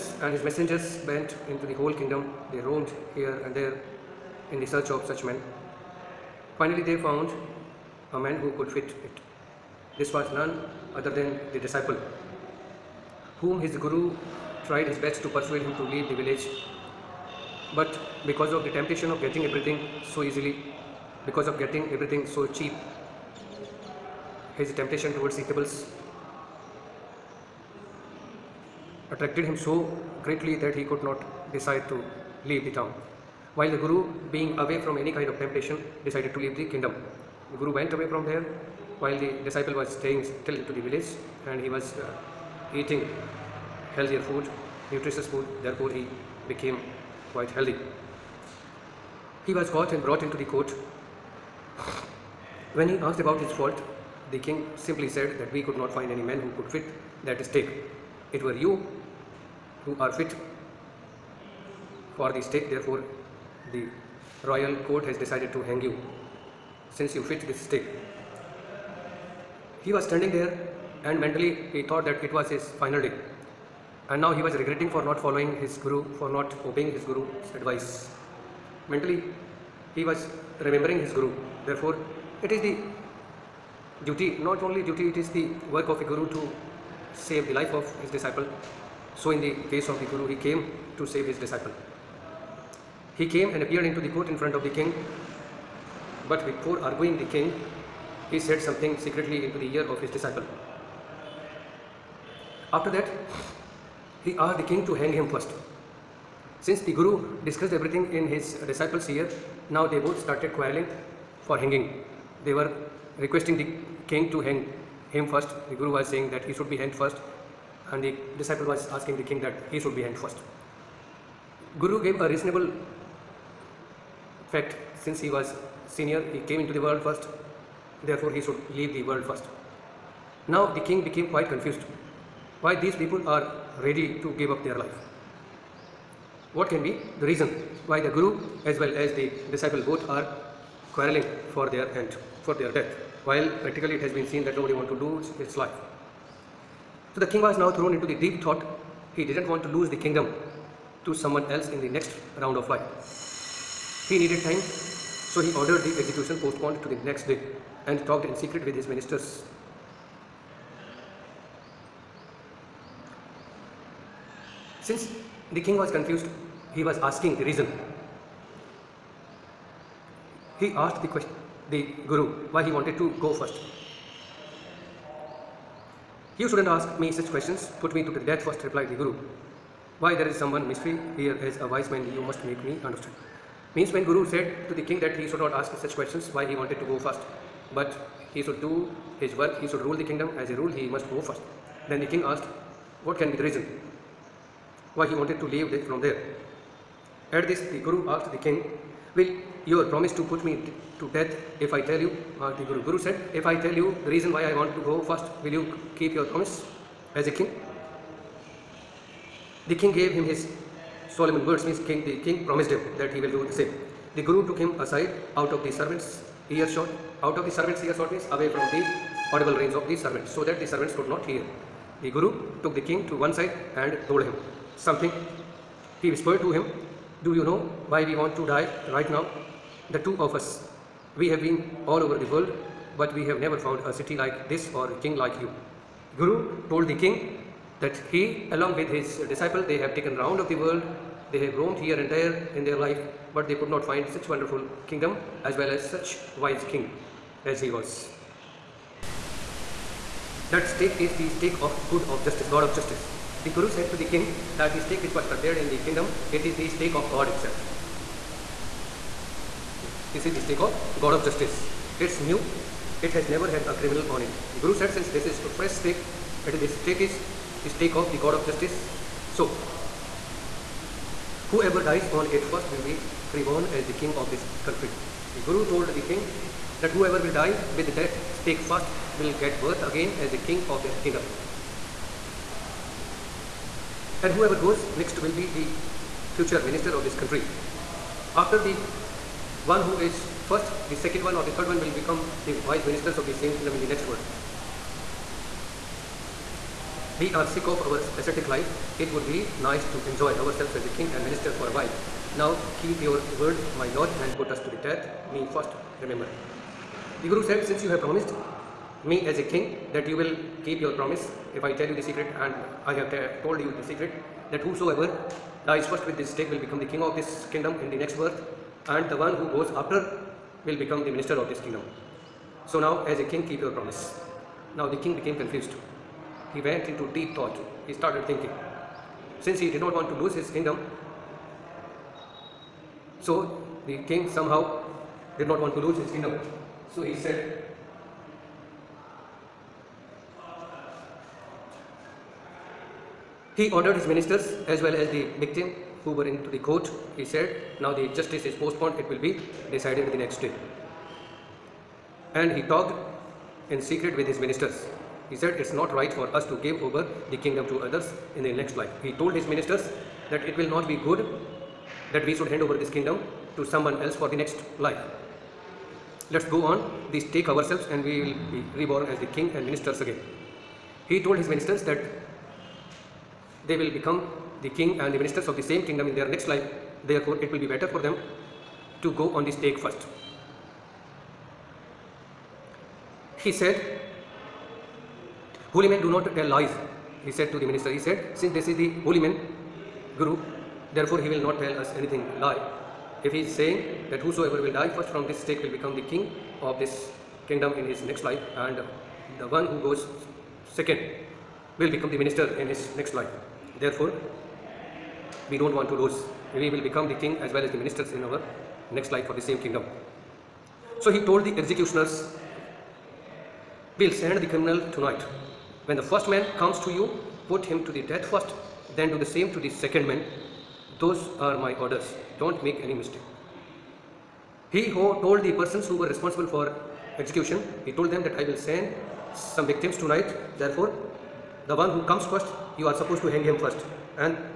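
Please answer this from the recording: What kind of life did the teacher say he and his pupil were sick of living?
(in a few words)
Ascetic life.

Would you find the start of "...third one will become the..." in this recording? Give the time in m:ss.
4:51.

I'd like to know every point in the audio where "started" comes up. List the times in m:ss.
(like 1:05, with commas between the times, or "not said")
1:50, 5:27.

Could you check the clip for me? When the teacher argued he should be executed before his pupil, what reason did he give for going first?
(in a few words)
He was senior.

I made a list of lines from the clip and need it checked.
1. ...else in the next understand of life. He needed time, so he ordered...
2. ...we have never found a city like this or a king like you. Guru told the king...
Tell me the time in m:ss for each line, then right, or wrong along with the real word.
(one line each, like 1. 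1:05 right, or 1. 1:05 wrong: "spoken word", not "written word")
1. 2:31 wrong: "round", not "understand"
2. 3:53 right.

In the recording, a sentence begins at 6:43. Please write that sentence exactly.
Therefore, we don't want to lose.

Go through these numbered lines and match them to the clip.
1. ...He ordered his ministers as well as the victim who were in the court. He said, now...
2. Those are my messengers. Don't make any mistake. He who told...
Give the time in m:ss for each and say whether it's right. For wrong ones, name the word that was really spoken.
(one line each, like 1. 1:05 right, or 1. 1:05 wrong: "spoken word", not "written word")
1. 5:43 right
2. 7:00 wrong: "orders", not "messengers".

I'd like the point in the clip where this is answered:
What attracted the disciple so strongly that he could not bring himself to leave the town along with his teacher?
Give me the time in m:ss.
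0:25.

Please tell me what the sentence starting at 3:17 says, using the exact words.
At this, the Guru asked the king, Will your promise to put me to death if I tell you, the Guru.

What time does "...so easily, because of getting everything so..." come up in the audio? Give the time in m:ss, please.
0:20.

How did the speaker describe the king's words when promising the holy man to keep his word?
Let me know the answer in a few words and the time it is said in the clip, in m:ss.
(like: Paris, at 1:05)
Solomon words, at 3:31.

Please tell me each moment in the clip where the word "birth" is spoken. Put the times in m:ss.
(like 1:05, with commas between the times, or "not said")
4:39, 5:18.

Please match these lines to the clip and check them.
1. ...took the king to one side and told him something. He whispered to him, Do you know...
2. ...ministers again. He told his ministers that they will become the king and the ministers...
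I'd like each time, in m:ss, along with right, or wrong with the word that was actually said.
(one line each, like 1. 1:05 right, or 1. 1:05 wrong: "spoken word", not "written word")
1. 3:42 right
2. 6:09 right.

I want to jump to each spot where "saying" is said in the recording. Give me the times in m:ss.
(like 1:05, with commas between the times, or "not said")
1:56, 6:33.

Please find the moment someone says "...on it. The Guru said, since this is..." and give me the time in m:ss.
4:24.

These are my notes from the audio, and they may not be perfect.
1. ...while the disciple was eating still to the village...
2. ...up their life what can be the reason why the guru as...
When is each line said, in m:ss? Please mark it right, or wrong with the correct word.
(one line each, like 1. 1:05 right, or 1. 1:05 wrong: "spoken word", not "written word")
1. 0:39 wrong: "staying", not "eating"
2. 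2:14 right.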